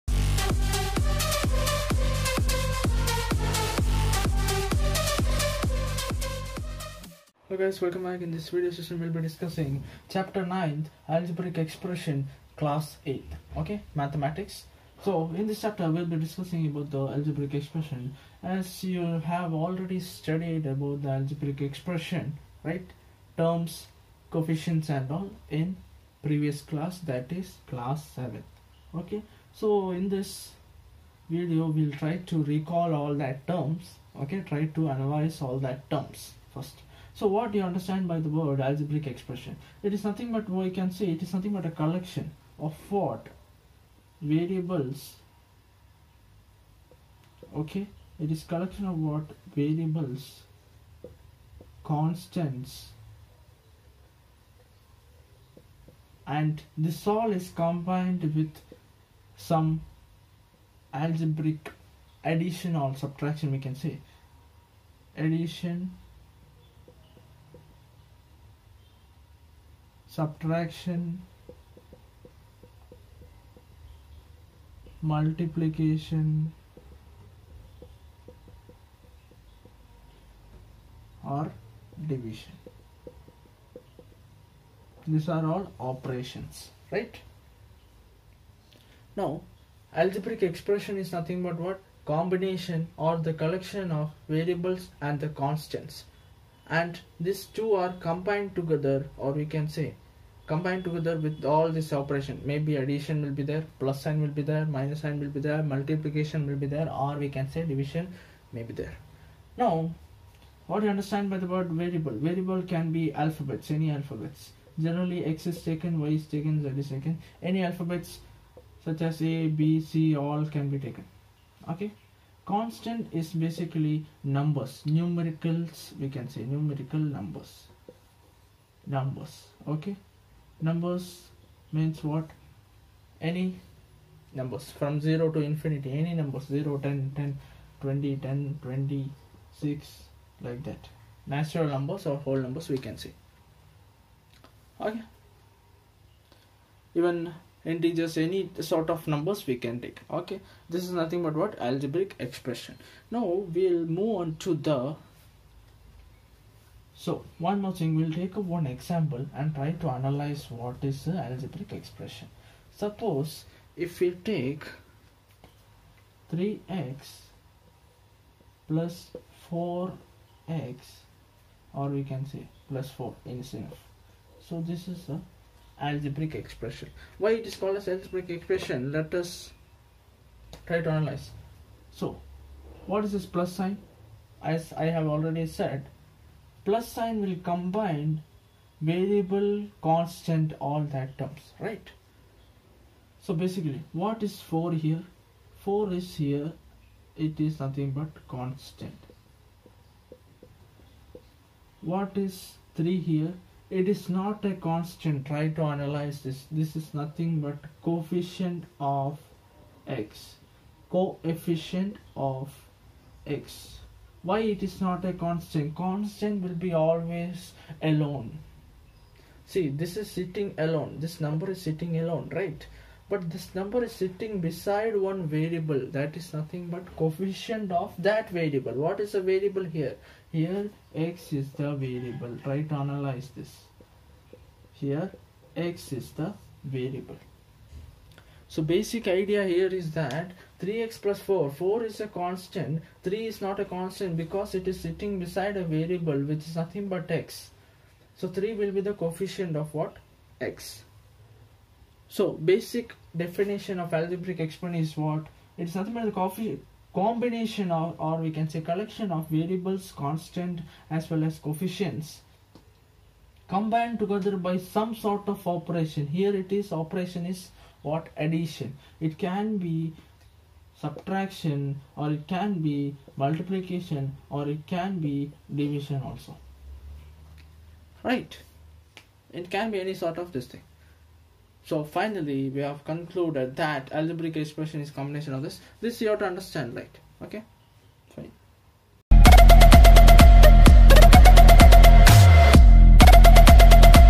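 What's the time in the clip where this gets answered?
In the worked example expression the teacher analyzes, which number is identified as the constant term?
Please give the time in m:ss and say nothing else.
3:15.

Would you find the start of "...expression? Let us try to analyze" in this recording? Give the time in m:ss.
2:58.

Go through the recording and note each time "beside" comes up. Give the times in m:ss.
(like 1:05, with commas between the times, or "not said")
3:44, 4:05.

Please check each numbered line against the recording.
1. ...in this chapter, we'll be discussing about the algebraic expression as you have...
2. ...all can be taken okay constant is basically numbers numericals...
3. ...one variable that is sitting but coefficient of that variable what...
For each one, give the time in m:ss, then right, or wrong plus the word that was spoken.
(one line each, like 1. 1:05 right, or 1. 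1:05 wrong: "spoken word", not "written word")
1. 0:15 right
2. 2:00 right
3. 3:45 wrong: "nothing", not "sitting".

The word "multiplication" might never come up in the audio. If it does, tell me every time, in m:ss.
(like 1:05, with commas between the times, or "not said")
1:15, 1:45, 4:33.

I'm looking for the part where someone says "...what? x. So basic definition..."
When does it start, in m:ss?
4:09.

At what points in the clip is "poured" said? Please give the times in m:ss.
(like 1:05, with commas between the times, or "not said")
not said.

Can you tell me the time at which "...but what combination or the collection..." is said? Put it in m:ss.
1:31.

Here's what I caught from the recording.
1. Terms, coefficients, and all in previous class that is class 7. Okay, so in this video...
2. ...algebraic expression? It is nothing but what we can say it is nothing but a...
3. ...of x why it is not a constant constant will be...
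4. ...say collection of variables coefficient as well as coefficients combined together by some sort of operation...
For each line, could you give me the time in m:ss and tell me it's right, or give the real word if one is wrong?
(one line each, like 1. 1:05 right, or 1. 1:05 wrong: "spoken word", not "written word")
1. 0:23 right
2. 0:38 right
3. 3:32 right
4. 4:18 wrong: "constant", not "coefficient".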